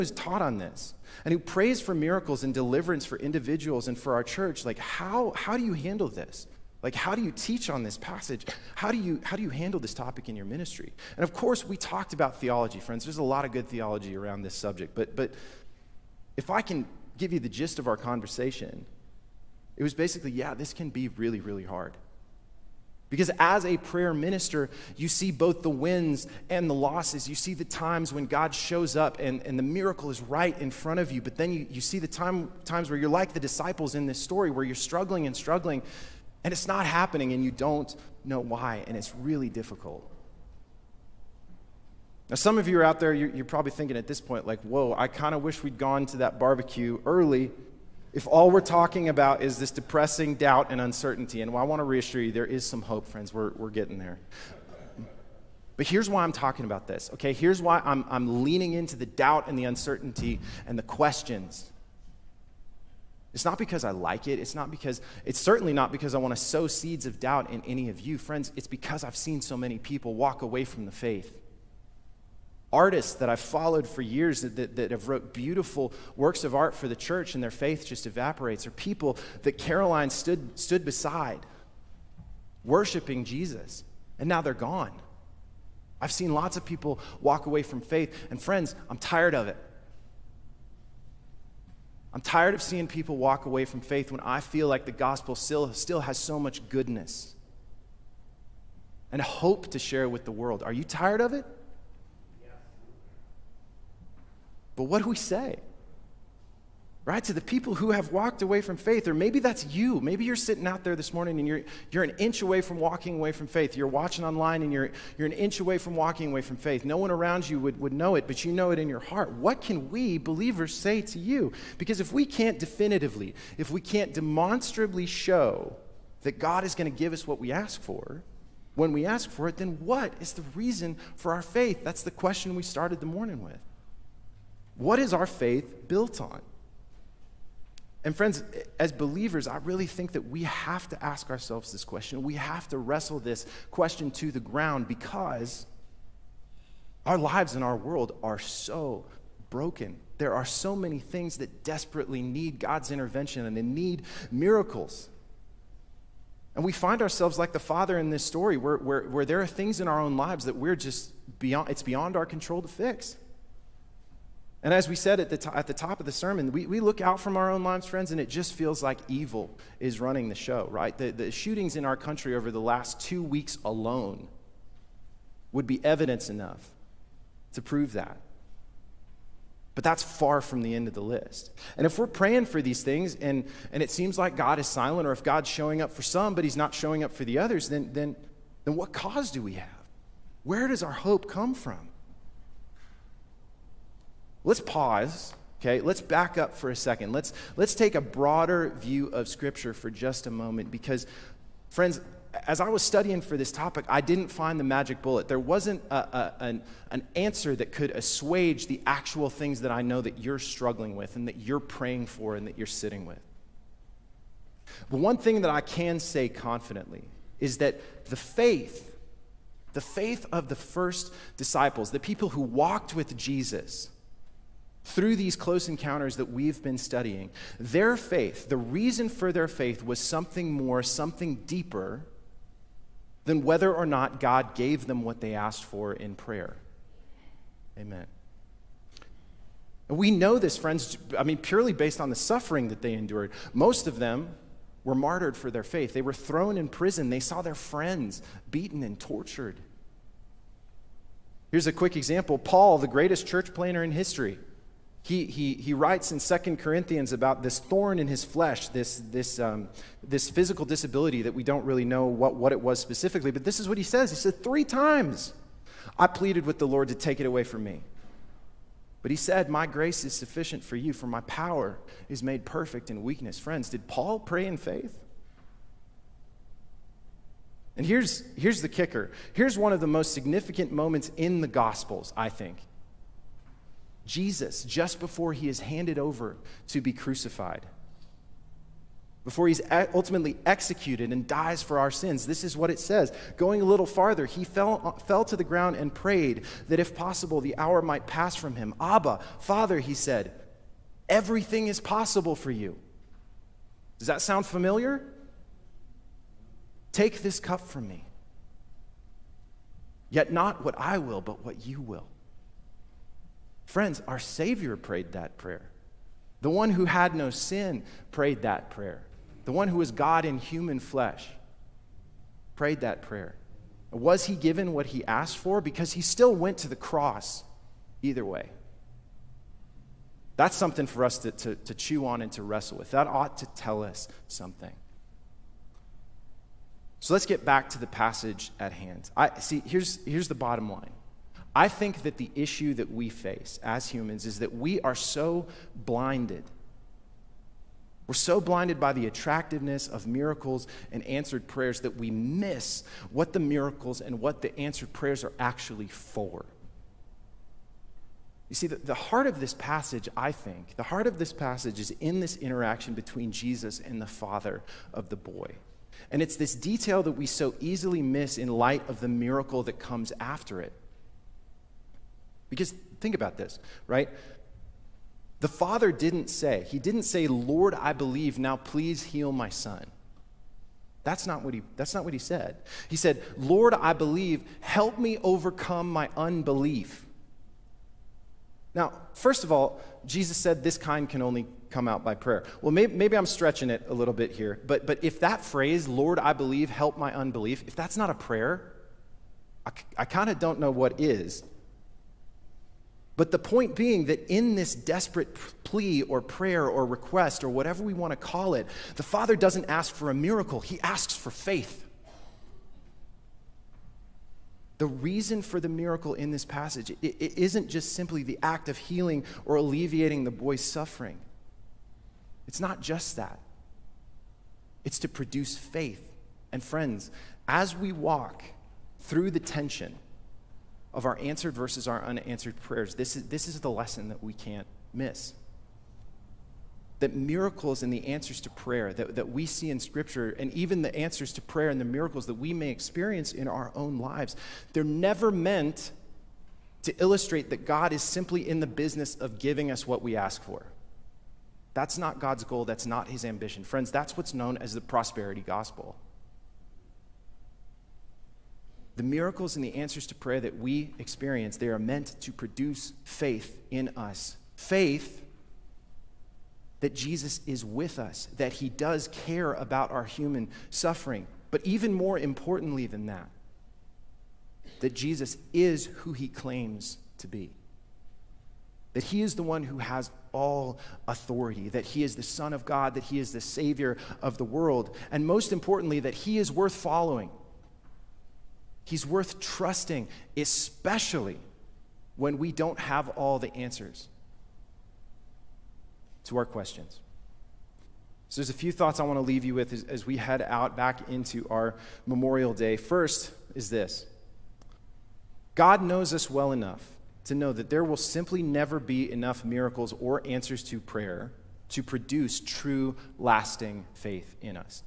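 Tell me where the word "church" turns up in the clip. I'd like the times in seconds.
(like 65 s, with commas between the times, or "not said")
4 s, 76 s, 253 s.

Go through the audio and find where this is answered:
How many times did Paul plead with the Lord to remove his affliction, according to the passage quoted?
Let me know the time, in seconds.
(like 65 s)
264 s.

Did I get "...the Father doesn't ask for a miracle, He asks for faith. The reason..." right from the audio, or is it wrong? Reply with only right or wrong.
right.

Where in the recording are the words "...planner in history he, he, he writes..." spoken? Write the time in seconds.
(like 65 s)
253 s.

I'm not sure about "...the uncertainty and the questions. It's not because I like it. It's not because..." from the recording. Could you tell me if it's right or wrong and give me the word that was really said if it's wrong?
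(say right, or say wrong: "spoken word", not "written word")
right.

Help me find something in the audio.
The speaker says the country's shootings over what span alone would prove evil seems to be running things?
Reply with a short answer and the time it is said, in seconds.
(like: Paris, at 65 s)
two weeks, at 173 s.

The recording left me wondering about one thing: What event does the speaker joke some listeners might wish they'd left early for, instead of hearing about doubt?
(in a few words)
barbecue.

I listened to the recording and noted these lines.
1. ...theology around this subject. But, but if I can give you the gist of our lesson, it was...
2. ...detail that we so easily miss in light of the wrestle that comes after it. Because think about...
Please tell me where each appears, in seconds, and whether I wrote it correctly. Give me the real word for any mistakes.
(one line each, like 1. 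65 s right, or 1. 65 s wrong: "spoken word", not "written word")
1. 13 s wrong: "conversation", not "lesson"
2. 366 s wrong: "miracle", not "wrestle".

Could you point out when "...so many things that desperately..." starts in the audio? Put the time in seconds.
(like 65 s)
150 s.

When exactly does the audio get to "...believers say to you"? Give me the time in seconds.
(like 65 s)
120 s.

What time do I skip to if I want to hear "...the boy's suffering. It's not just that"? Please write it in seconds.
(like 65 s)
420 s.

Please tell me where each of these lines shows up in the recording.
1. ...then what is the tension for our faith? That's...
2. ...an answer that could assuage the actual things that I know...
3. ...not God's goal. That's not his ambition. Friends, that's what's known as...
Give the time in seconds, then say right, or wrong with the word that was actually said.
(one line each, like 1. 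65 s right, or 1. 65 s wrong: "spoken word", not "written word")
1. 129 s wrong: "reason", not "tension"
2. 206 s right
3. 451 s right.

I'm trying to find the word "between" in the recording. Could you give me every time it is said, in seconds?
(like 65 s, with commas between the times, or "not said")
362 s.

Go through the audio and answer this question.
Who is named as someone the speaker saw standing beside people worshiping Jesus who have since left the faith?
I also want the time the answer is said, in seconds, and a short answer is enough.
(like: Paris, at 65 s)
Caroline, at 79 s.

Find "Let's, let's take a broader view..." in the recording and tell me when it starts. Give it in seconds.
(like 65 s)
197 s.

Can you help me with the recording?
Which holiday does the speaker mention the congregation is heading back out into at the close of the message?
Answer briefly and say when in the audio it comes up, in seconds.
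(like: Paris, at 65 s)
Memorial Day, at 502 s.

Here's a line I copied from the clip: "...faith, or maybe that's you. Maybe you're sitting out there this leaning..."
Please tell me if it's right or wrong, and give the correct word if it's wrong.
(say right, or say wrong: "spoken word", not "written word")
wrong: "morning", not "leaning".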